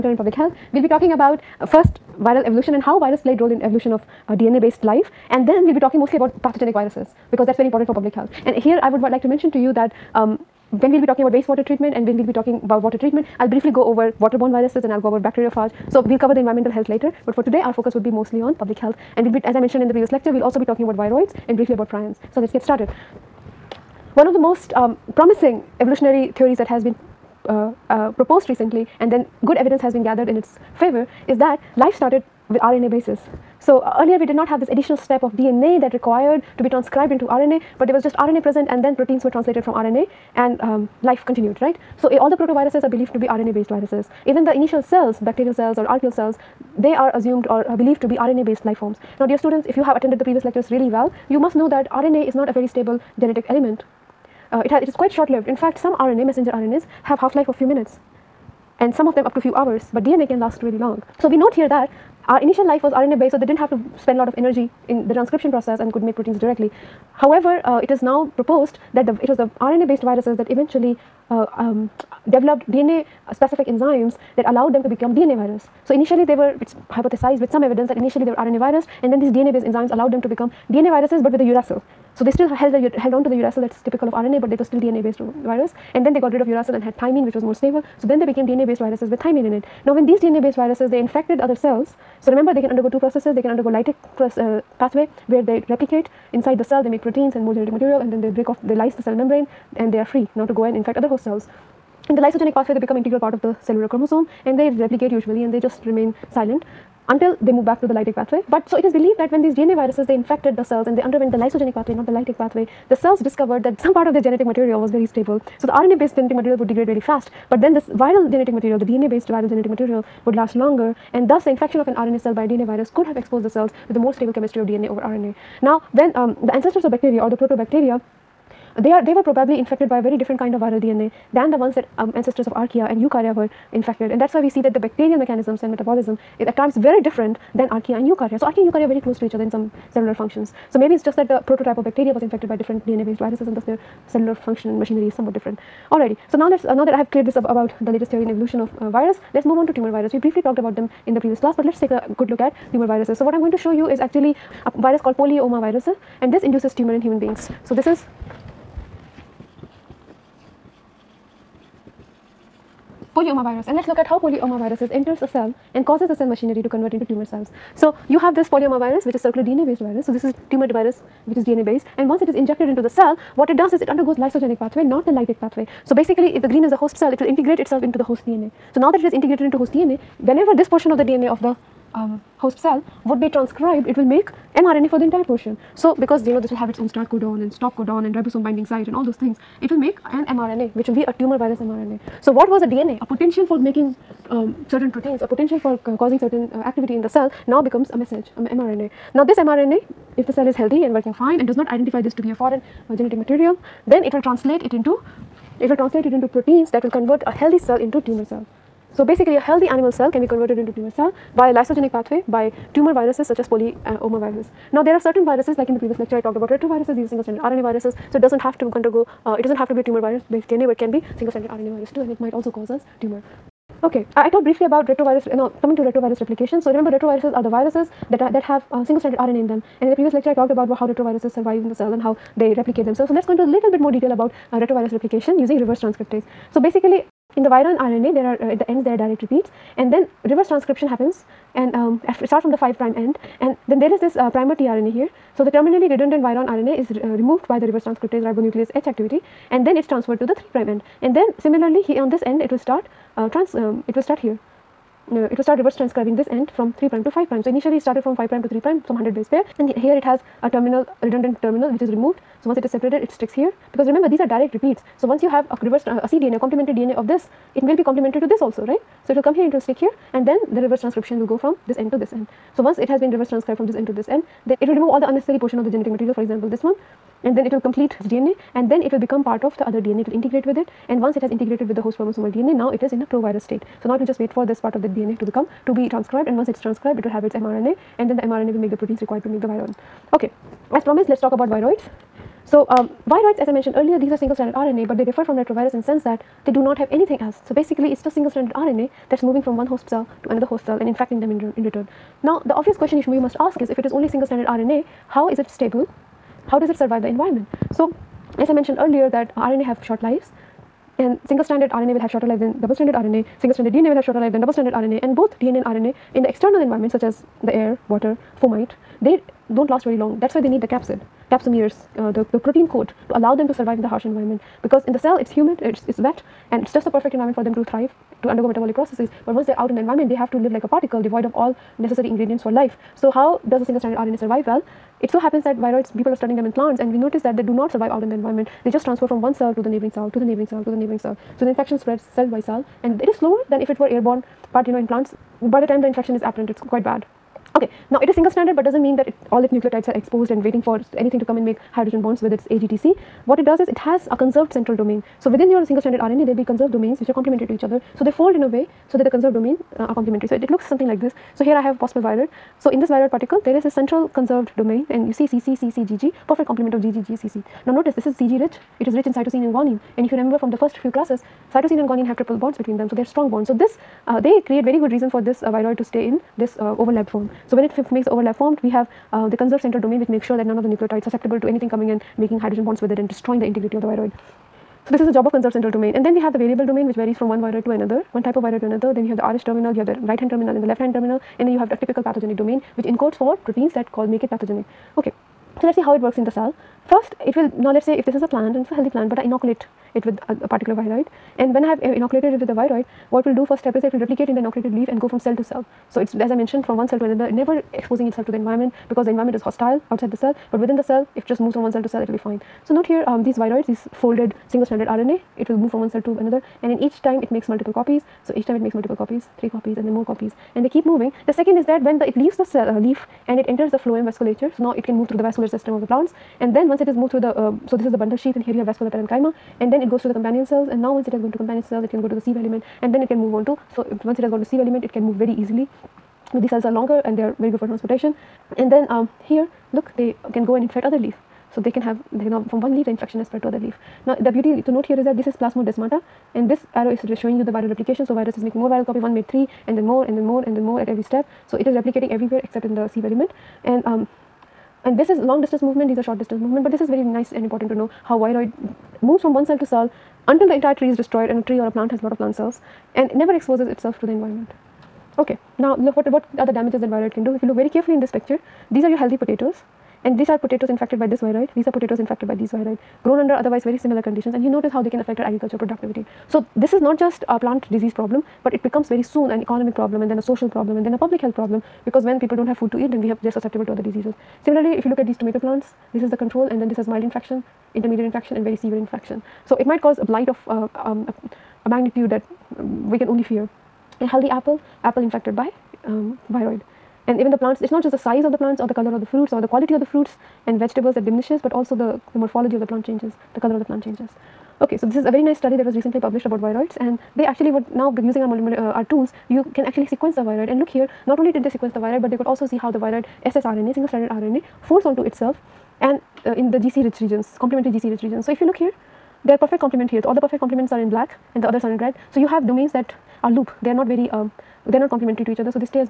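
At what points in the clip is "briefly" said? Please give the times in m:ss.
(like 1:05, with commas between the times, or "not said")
0:13, 0:21, 2:30, 3:44.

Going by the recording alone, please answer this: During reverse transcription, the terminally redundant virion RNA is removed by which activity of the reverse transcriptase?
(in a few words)
ribonuclease H.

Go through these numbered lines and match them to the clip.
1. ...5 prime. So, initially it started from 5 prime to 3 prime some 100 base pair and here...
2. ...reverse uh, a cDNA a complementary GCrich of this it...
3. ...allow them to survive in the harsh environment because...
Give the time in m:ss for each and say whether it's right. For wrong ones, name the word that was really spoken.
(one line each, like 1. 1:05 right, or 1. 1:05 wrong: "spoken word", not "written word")
1. 4:17 right
2. 4:25 wrong: "DNA", not "GCrich"
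3. 5:23 right.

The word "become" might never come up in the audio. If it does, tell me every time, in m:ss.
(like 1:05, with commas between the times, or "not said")
1:14, 1:20, 1:42, 3:17, 4:38, 4:45, 7:58.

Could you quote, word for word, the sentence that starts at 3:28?
So basically a healthy animal cell can be converted into tumor cell via lysogenic pathway by tumor viruses such as polyoma virus.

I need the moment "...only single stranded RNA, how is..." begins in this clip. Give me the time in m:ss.
5:03.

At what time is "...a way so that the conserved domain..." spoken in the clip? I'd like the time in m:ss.
5:58.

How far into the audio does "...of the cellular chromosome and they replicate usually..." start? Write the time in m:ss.
1:43.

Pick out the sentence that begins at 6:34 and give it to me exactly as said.
Okay, so let's see how it works in the cell.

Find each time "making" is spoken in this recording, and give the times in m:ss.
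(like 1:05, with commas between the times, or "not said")
3:13, 6:22, 7:28.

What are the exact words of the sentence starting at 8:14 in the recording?
A healthy apple, apple infected by um, viroid.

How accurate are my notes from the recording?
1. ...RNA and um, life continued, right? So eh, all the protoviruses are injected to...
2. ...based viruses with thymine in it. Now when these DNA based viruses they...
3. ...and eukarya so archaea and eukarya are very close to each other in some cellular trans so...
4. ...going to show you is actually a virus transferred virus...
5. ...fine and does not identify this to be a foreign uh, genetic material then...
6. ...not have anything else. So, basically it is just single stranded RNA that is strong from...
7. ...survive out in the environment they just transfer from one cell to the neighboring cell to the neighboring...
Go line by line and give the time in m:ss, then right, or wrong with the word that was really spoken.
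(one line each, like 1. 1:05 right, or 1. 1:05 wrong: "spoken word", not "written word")
1. 0:39 wrong: "believed", not "injected"
2. 1:28 right
3. 2:17 wrong: "functions", not "trans"
4. 2:33 wrong: "called", not "transferred"
5. 3:21 right
6. 4:56 wrong: "moving", not "strong"
7. 5:37 right.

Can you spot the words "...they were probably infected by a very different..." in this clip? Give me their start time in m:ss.
2:09.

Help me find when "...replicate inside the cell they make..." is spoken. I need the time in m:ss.
1:35.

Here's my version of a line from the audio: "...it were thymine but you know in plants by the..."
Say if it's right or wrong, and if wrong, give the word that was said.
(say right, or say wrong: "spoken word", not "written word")
wrong: "airborne", not "thymine".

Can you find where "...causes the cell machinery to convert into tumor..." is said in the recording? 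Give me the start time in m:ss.
2:45.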